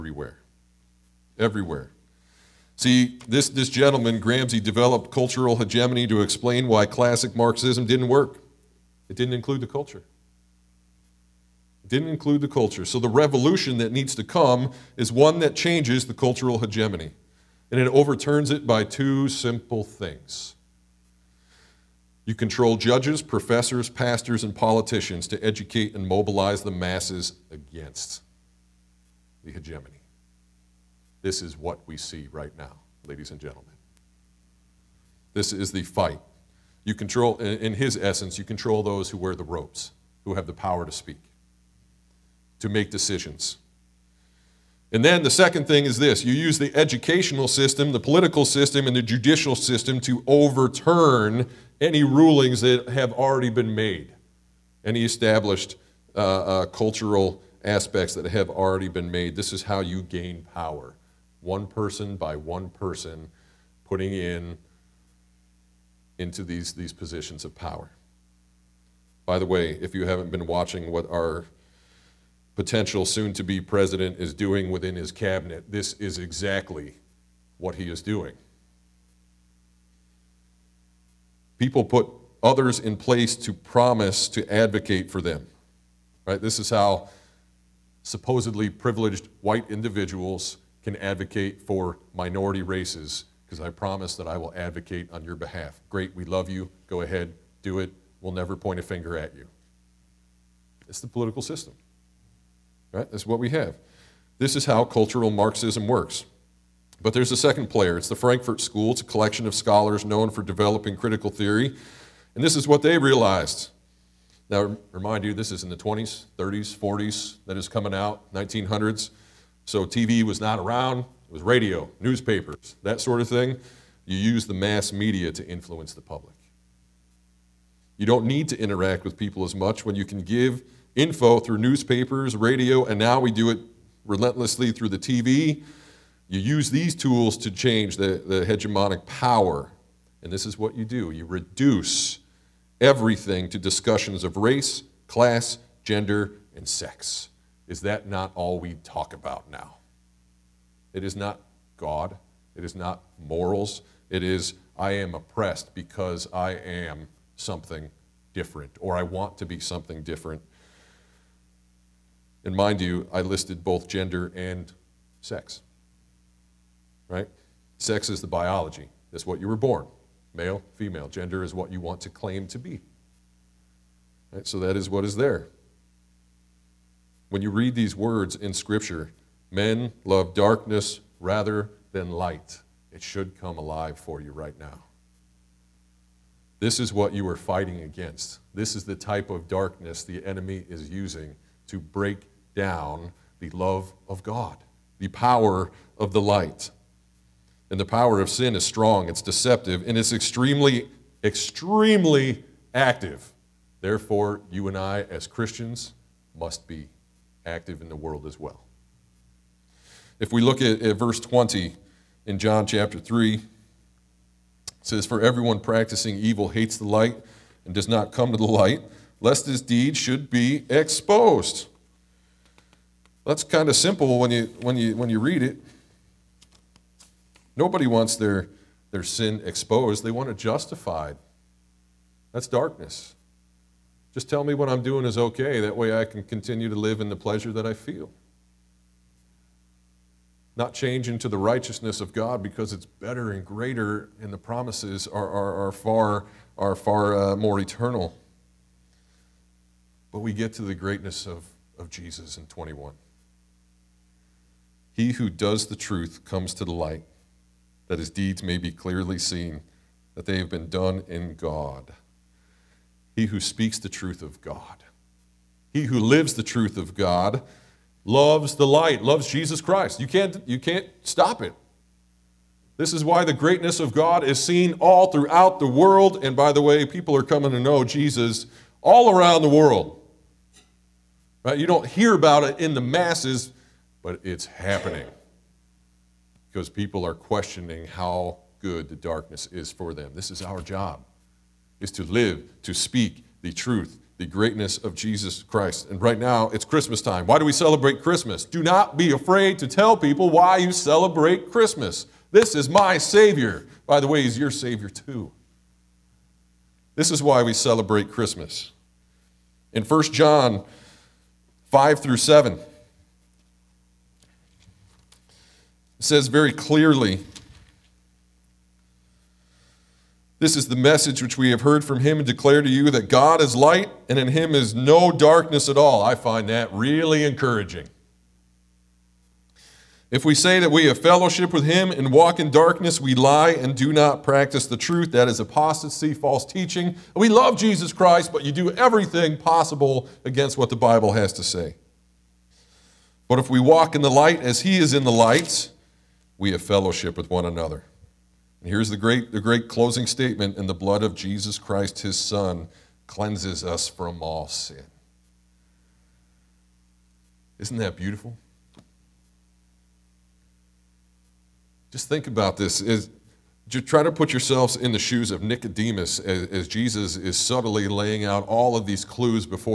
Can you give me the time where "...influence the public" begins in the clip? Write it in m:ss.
2:05.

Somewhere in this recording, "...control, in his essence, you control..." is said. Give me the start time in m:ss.
0:36.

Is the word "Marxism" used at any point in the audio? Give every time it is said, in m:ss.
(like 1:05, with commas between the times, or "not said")
0:07, 1:45.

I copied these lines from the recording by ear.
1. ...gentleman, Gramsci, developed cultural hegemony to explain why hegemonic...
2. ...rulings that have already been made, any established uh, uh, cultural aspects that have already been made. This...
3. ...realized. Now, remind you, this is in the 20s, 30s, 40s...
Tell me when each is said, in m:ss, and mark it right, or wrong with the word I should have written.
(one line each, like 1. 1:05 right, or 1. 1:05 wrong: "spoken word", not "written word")
1. 0:03 wrong: "classic", not "hegemonic"
2. 0:52 right
3. 1:52 right.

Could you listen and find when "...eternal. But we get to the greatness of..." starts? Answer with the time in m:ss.
4:07.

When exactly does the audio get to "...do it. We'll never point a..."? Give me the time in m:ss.
1:37.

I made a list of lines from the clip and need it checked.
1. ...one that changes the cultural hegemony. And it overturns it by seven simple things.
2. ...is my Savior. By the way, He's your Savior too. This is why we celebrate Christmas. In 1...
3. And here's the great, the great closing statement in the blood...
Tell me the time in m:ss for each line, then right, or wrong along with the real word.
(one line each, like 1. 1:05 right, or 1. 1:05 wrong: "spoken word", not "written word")
1. 0:15 wrong: "two", not "seven"
2. 5:02 right
3. 5:48 right.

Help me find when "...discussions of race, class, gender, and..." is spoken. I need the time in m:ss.
2:23.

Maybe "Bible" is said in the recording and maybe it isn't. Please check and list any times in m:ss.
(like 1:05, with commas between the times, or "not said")
5:40.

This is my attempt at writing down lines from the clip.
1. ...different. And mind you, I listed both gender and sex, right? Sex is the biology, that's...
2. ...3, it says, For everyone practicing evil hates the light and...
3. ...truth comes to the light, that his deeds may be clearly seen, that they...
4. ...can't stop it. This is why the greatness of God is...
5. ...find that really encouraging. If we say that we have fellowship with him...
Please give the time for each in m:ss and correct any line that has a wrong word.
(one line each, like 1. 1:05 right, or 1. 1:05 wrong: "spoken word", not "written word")
1. 2:40 right
2. 3:32 right
3. 4:15 right
4. 4:30 right
5. 5:26 right.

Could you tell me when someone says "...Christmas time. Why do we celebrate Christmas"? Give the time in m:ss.
4:56.